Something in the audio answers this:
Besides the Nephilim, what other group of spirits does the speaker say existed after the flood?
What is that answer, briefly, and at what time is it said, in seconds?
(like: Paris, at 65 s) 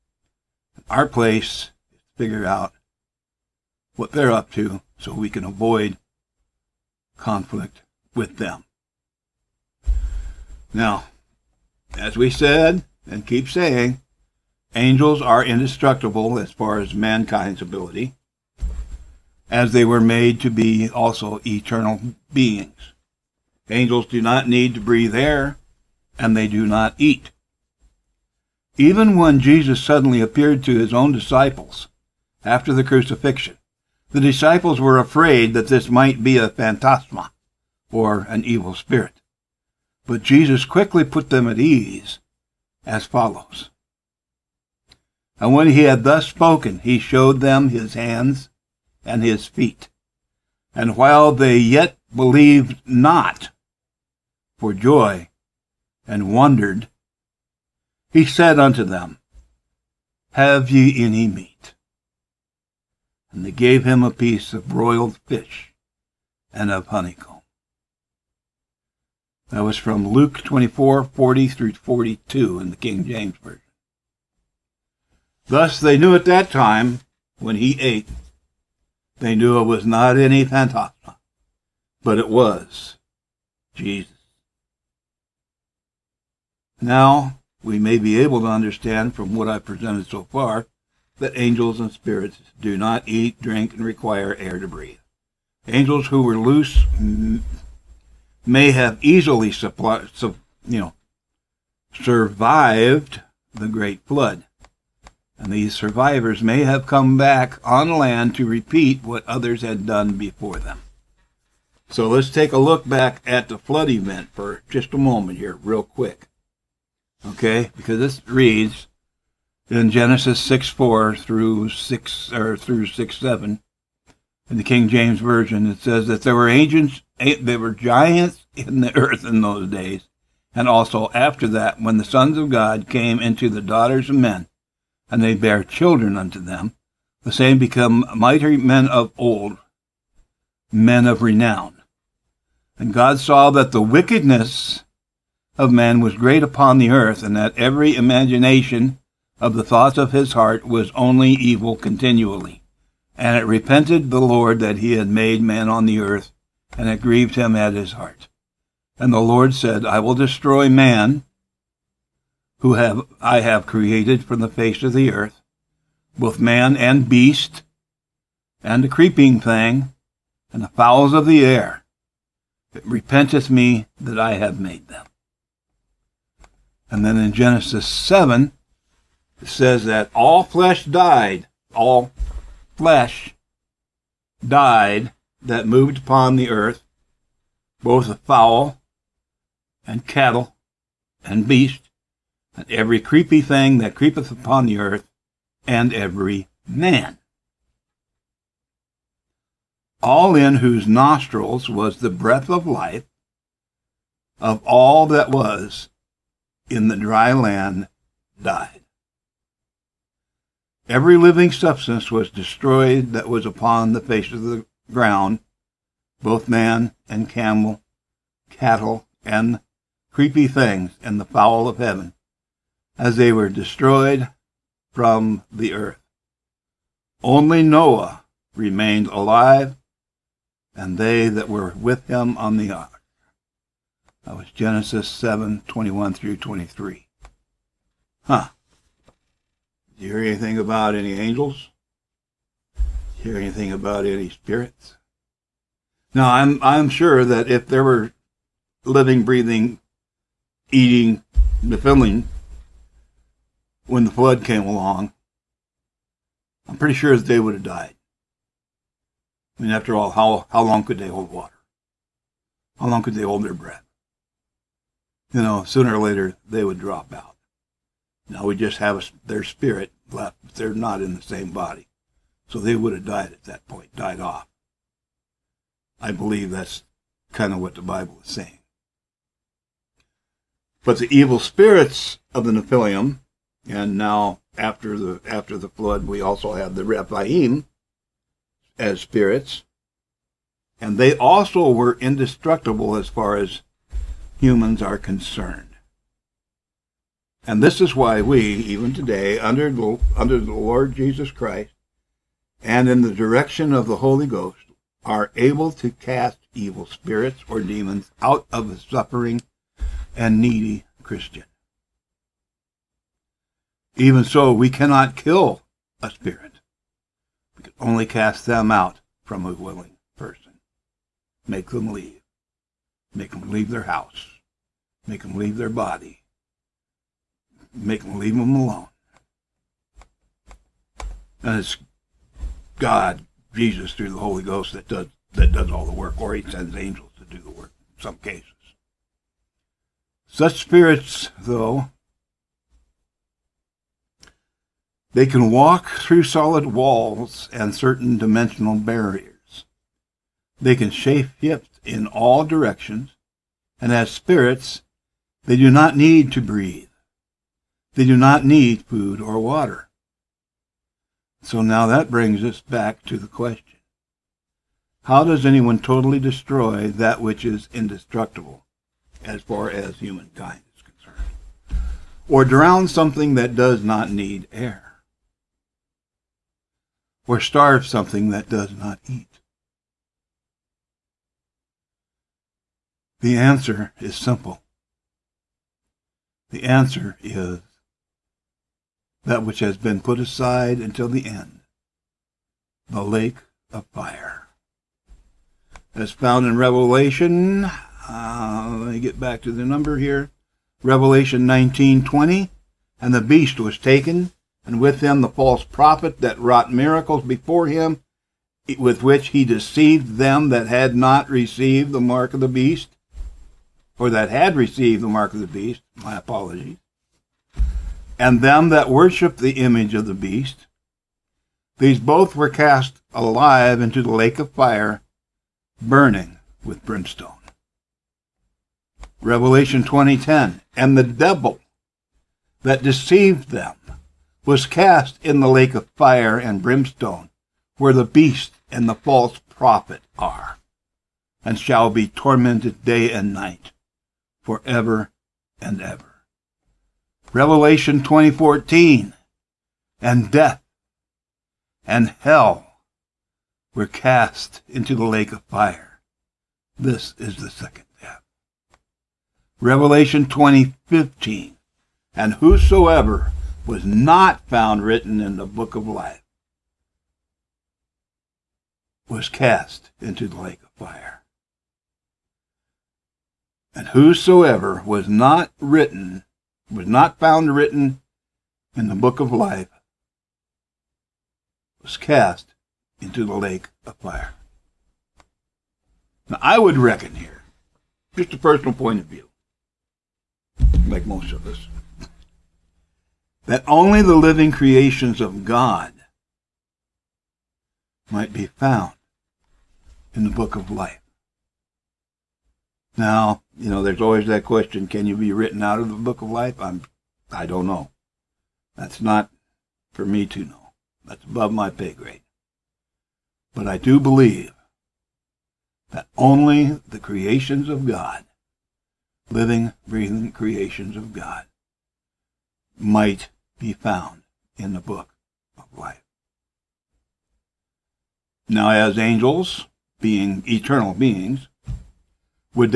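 Rephaim, at 286 s.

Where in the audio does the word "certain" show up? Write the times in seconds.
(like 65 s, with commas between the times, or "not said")
347 s.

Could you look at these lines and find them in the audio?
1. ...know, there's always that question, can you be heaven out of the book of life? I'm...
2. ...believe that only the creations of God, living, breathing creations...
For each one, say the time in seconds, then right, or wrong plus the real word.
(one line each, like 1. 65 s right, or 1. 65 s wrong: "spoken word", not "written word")
1. 503 s wrong: "written", not "heaven"
2. 514 s right.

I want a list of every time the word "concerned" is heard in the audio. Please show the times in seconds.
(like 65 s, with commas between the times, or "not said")
294 s, 370 s.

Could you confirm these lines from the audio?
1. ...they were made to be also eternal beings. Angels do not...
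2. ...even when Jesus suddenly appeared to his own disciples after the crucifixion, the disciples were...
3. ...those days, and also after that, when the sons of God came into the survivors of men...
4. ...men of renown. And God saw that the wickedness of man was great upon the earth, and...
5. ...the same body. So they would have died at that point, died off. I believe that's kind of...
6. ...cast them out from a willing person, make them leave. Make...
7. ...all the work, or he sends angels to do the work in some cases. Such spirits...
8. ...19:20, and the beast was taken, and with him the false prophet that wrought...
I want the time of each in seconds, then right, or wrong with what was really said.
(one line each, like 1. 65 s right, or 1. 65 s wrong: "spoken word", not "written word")
1. 19 s right
2. 28 s right
3. 129 s wrong: "daughters", not "survivors"
4. 140 s right
5. 271 s right
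6. 318 s right
7. 335 s right
8. 401 s right.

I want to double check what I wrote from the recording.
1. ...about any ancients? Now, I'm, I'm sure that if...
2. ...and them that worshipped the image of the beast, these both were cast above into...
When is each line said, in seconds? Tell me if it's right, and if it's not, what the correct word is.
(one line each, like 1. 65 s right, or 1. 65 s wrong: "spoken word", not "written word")
1. 243 s wrong: "spirits", not "ancients"
2. 418 s wrong: "alive", not "above".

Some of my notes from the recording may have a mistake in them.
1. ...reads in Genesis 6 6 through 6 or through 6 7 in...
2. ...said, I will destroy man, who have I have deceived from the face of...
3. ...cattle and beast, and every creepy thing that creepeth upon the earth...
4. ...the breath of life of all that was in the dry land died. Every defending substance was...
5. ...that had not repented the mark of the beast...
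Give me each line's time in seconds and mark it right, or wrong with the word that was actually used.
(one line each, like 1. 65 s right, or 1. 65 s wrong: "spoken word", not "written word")
1. 118 s wrong: "4", not "6"
2. 159 s wrong: "created", not "deceived"
3. 190 s right
4. 201 s wrong: "living", not "defending"
5. 410 s wrong: "received", not "repented".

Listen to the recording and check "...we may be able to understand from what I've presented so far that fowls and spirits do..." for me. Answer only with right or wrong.
wrong.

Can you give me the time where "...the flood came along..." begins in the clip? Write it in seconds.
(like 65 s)
254 s.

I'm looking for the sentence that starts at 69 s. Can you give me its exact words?
That was from Luke 24, 40 through 42 in the King James Version.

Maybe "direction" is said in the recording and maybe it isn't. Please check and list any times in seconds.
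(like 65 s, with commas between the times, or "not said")
303 s, 352 s.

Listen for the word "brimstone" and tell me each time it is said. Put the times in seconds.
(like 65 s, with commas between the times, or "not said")
426 s, 436 s.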